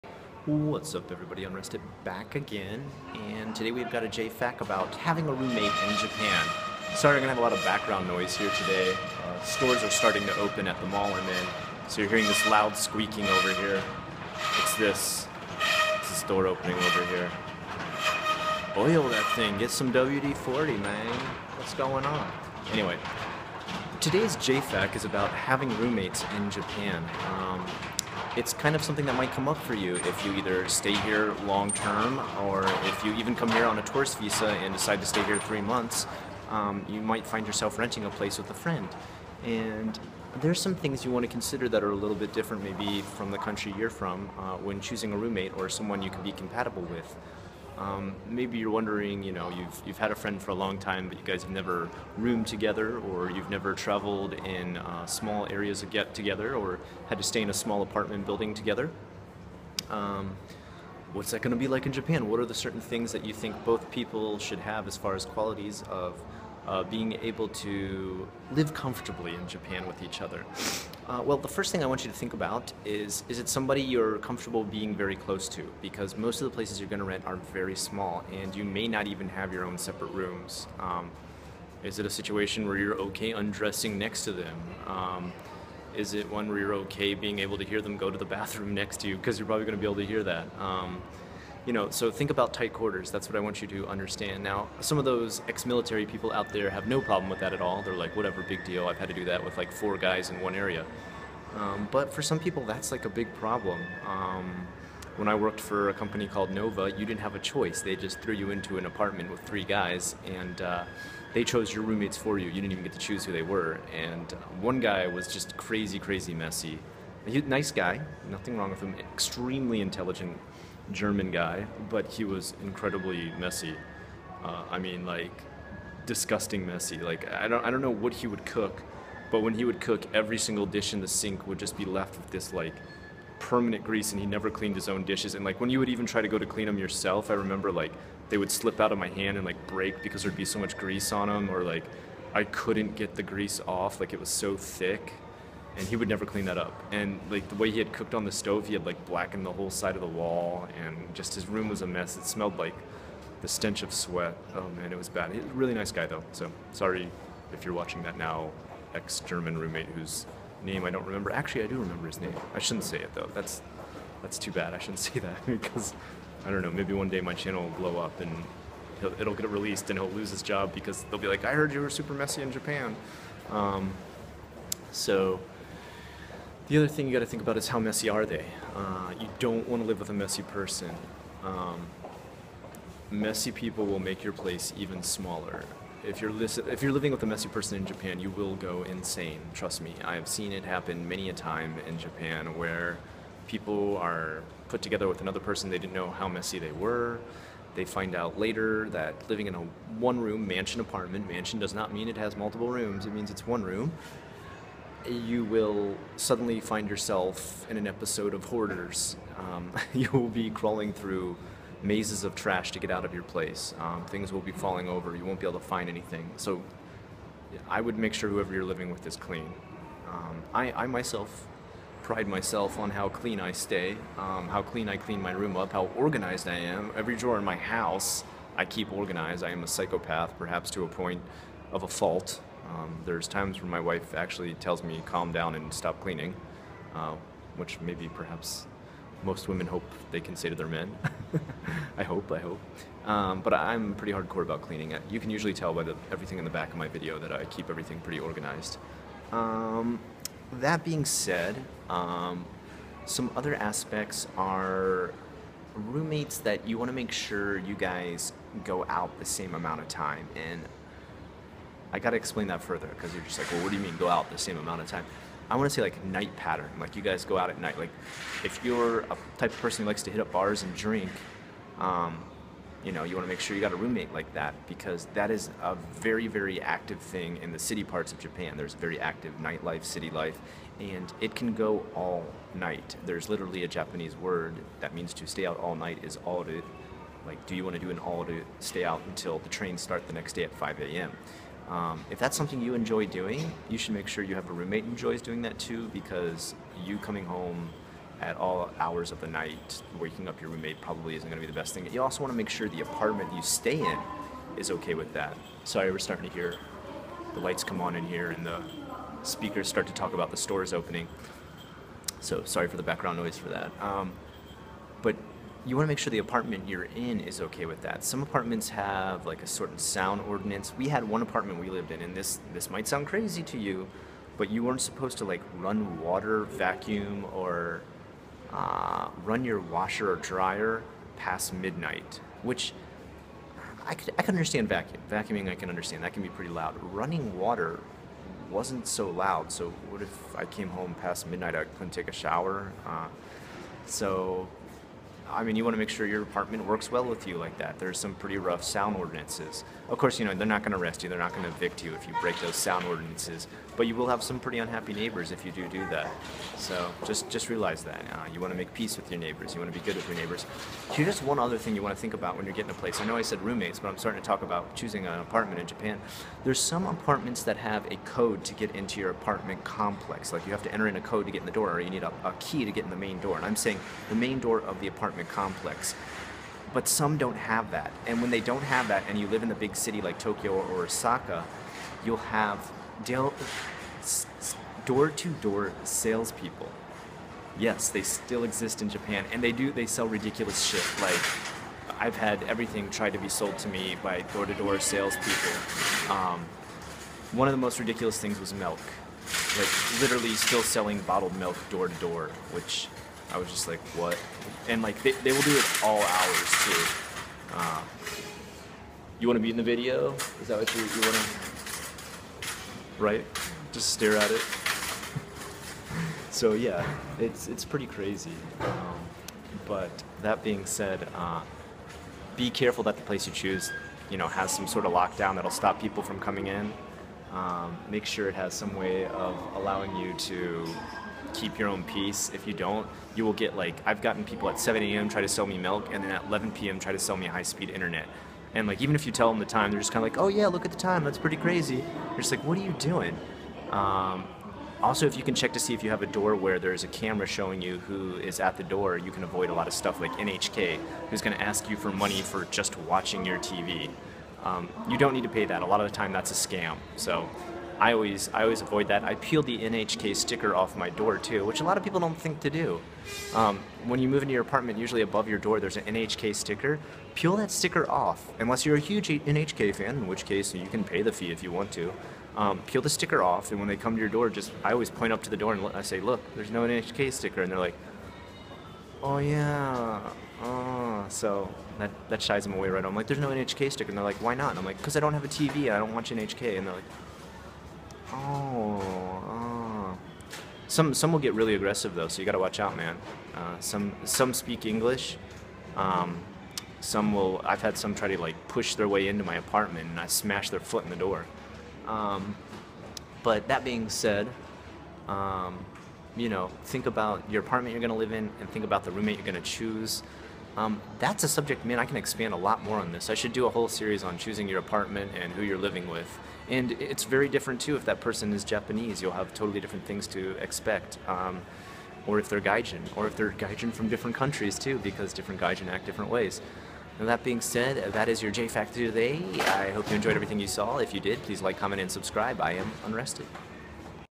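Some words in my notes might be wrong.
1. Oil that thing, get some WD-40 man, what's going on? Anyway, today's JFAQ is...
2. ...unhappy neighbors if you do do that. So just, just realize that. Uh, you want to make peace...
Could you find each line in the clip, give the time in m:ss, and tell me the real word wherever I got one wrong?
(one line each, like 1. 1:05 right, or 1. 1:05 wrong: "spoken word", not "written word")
1. 0:18 right
2. 5:54 right.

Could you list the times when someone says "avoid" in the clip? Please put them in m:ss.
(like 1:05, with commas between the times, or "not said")
7:29, 7:38.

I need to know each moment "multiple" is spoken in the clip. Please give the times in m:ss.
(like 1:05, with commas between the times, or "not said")
3:22.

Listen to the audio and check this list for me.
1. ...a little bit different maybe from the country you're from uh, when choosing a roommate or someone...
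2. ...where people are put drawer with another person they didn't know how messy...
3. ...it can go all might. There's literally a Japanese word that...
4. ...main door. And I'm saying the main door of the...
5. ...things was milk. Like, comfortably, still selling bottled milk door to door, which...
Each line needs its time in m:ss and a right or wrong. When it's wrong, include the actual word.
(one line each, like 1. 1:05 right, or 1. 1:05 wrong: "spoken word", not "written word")
1. 0:41 right
2. 3:12 wrong: "together", not "drawer"
3. 4:41 wrong: "night", not "might"
4. 6:12 right
5. 6:38 wrong: "literally", not "comfortably".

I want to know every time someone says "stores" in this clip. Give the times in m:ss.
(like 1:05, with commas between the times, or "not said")
0:09, 5:10.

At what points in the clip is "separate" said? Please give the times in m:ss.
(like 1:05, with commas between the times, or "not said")
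1:19.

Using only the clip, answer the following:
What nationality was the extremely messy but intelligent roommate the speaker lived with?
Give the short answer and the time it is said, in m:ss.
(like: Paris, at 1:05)
German, at 2:00.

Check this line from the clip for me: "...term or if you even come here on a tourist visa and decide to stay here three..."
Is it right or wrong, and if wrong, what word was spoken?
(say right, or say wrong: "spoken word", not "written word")
right.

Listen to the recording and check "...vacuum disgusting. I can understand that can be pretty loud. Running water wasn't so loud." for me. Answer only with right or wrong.
wrong.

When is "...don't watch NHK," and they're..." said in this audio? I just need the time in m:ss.
8:05.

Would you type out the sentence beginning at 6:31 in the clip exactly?
Like, I've had everything tried to be sold to me by door to door salespeople.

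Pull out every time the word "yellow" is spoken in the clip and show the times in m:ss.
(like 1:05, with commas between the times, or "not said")
not said.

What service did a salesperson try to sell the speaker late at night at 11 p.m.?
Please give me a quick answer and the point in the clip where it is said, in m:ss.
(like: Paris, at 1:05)
high-speed internet, at 7:17.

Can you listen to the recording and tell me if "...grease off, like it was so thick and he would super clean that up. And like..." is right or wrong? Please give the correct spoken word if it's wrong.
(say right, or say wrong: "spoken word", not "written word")
wrong: "never", not "super".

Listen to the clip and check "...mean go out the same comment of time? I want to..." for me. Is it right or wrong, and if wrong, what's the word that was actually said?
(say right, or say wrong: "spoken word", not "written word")
wrong: "amount", not "comment".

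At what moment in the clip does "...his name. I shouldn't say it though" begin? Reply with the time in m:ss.
2:42.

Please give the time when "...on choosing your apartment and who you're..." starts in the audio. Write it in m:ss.
8:34.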